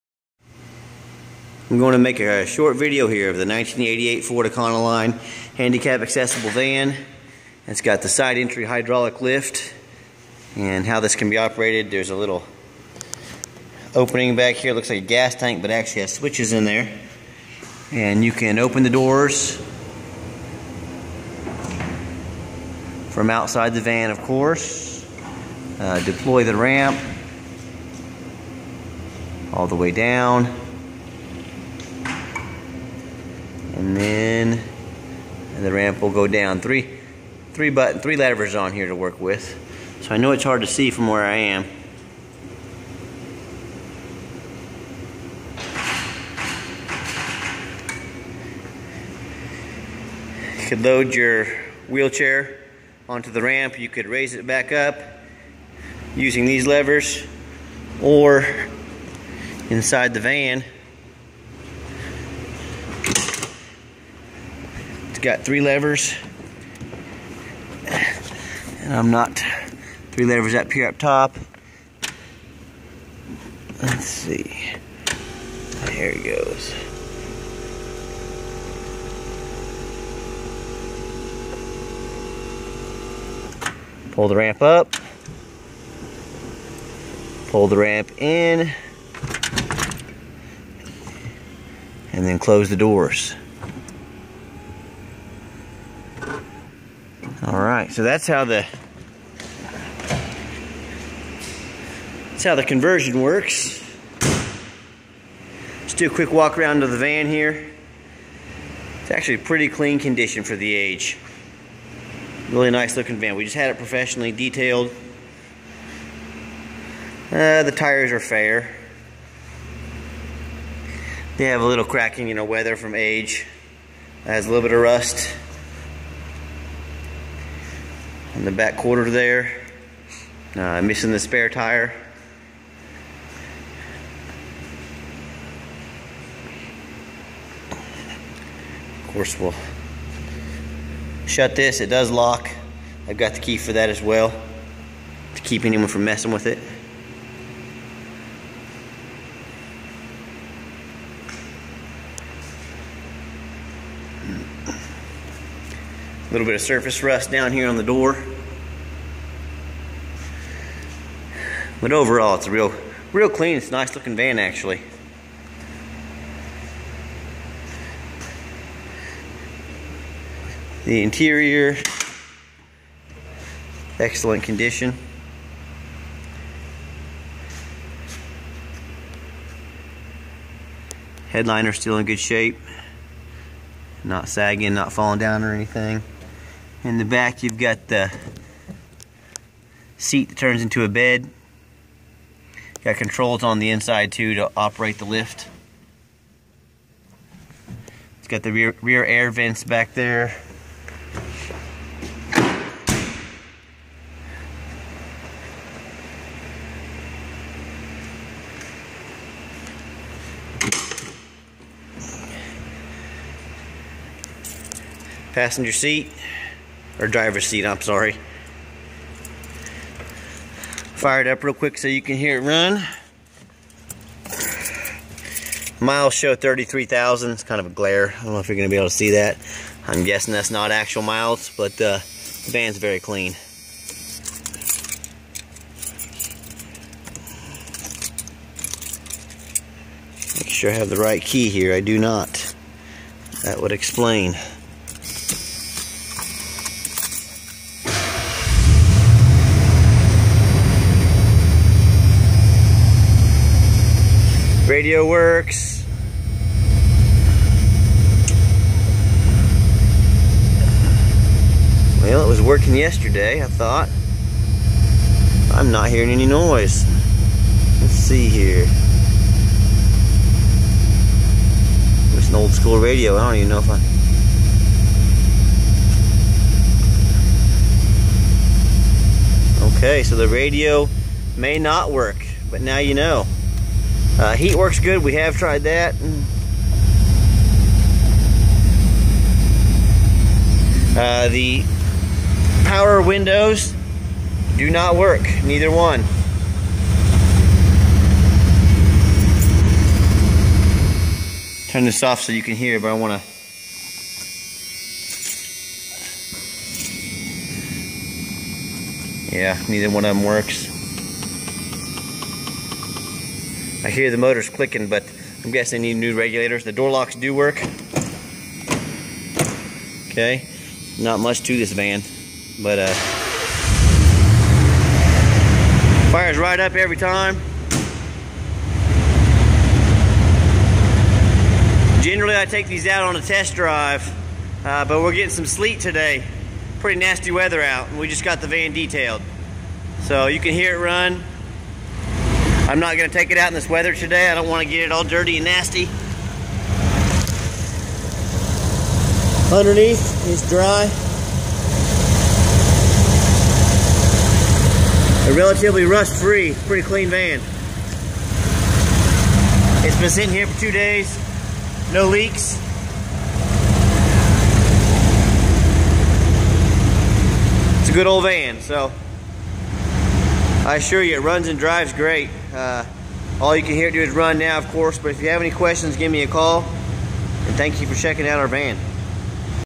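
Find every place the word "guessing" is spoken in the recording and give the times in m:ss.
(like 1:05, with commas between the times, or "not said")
3:50, 5:15.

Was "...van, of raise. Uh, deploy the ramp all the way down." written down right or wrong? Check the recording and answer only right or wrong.
wrong.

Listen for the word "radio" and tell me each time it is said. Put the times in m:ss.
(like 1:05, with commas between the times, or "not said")
4:14, 4:32, 4:40.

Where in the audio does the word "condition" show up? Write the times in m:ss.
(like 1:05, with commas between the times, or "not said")
1:49, 2:54.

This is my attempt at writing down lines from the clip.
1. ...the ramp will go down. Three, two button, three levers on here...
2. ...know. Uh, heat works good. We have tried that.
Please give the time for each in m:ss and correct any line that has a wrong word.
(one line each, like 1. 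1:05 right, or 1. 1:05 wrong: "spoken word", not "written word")
1. 0:35 wrong: "three", not "two"
2. 4:42 right.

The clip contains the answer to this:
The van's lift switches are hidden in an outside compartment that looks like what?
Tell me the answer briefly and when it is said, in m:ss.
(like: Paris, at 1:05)
gas tank, at 0:15.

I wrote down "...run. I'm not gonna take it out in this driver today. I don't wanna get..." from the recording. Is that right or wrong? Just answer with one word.
wrong.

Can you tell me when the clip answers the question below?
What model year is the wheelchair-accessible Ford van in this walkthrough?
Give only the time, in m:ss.
0:03.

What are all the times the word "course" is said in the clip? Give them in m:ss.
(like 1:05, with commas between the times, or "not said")
0:24, 2:19, 6:14.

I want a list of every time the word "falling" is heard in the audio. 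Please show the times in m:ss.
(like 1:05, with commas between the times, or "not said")
3:04.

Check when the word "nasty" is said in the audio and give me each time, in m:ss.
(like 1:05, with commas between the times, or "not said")
5:36, 5:45.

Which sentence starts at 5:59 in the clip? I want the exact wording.
It's been sitting here for two days, no leaks.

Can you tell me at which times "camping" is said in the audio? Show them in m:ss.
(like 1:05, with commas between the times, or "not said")
not said.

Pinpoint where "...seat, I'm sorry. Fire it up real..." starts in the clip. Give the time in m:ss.
3:37.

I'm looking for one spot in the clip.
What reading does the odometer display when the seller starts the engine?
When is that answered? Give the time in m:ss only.
3:46.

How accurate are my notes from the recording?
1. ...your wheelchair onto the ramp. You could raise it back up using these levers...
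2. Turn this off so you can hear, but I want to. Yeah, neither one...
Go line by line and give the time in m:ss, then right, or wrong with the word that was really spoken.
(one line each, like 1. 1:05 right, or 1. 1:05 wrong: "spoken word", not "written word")
1. 0:51 right
2. 5:01 right.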